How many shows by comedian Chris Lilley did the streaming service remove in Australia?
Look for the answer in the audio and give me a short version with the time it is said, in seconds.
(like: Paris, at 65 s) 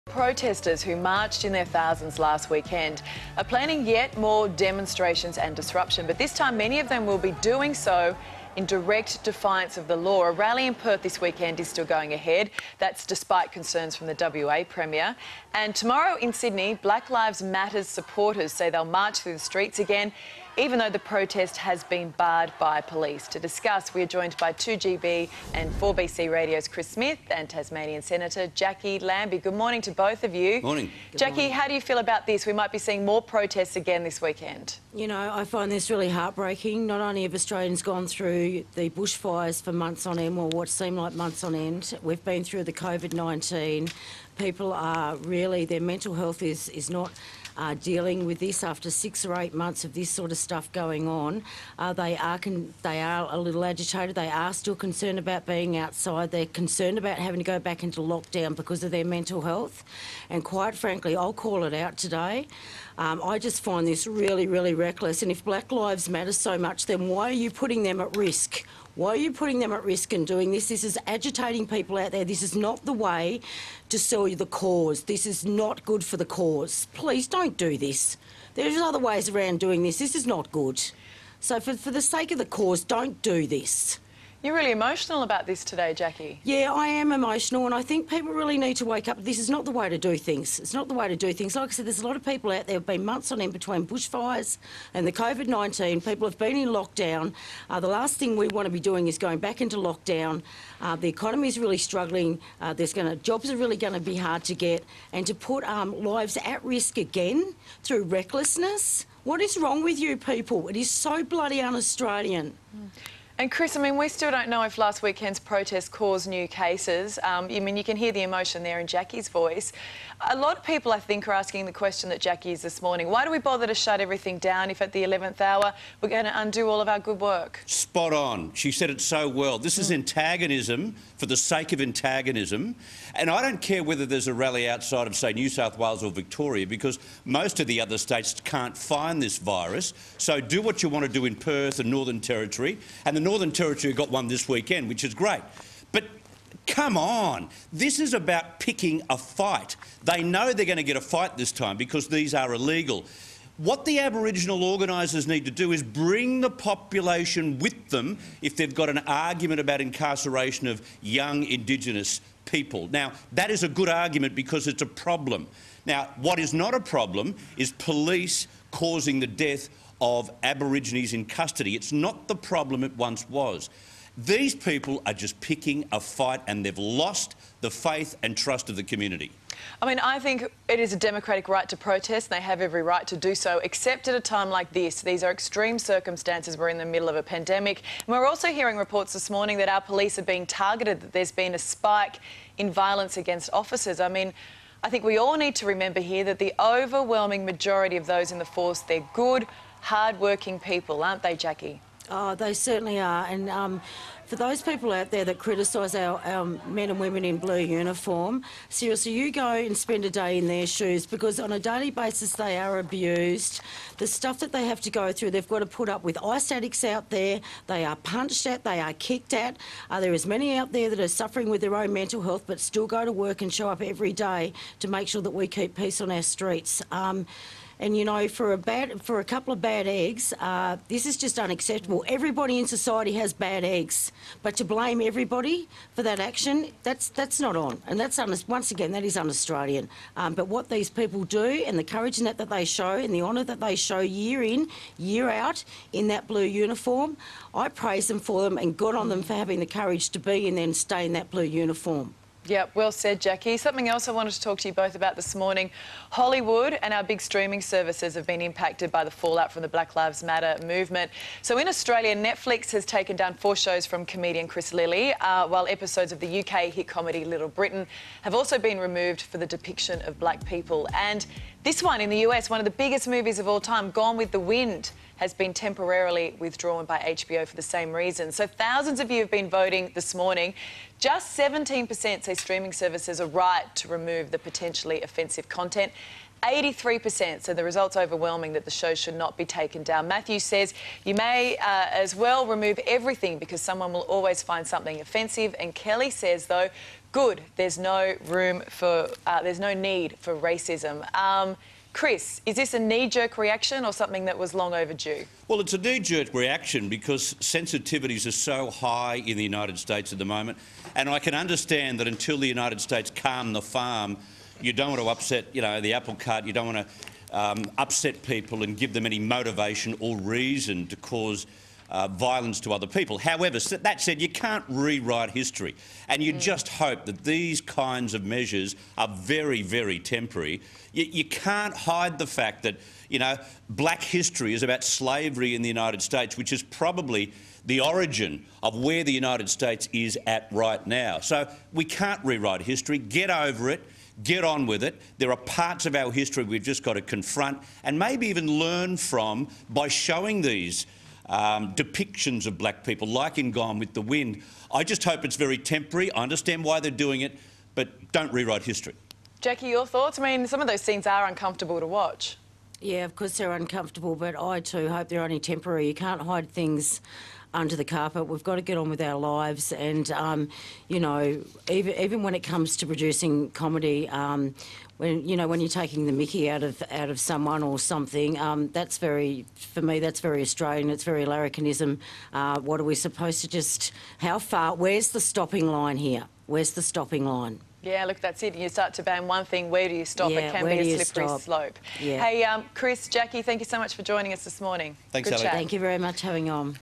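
4, at 263 s.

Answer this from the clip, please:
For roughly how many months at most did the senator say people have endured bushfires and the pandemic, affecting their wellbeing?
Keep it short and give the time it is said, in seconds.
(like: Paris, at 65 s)
8, at 49 s.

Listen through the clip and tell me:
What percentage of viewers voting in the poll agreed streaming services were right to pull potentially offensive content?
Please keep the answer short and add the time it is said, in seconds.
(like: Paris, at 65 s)
17%, at 281 s.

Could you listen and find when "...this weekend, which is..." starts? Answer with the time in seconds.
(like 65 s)
144 s.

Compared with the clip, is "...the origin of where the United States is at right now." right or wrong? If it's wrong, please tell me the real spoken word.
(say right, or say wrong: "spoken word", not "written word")
right.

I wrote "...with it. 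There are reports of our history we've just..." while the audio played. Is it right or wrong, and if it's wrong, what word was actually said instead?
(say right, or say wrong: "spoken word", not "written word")
wrong: "parts", not "reports".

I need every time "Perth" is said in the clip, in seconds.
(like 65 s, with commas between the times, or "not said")
10 s, 141 s.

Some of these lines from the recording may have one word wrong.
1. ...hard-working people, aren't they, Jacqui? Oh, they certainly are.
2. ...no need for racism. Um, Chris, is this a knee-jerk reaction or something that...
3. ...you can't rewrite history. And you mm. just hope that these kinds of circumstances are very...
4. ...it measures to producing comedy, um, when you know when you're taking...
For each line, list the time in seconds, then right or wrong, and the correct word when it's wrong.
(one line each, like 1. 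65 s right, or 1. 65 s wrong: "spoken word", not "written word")
1. 199 s right
2. 299 s right
3. 324 s wrong: "measures", not "circumstances"
4. 372 s wrong: "comes", not "measures".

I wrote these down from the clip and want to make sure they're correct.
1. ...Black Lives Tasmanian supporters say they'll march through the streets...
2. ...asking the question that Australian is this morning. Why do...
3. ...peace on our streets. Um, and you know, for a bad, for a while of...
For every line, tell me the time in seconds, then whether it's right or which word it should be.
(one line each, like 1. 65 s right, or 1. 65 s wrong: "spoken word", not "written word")
1. 16 s wrong: "Matters", not "Tasmanian"
2. 121 s wrong: "Jacqui", not "Australian"
3. 225 s wrong: "couple", not "while".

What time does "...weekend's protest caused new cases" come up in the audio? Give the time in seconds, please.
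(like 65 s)
115 s.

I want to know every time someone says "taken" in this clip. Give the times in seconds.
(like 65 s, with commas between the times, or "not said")
262 s, 289 s.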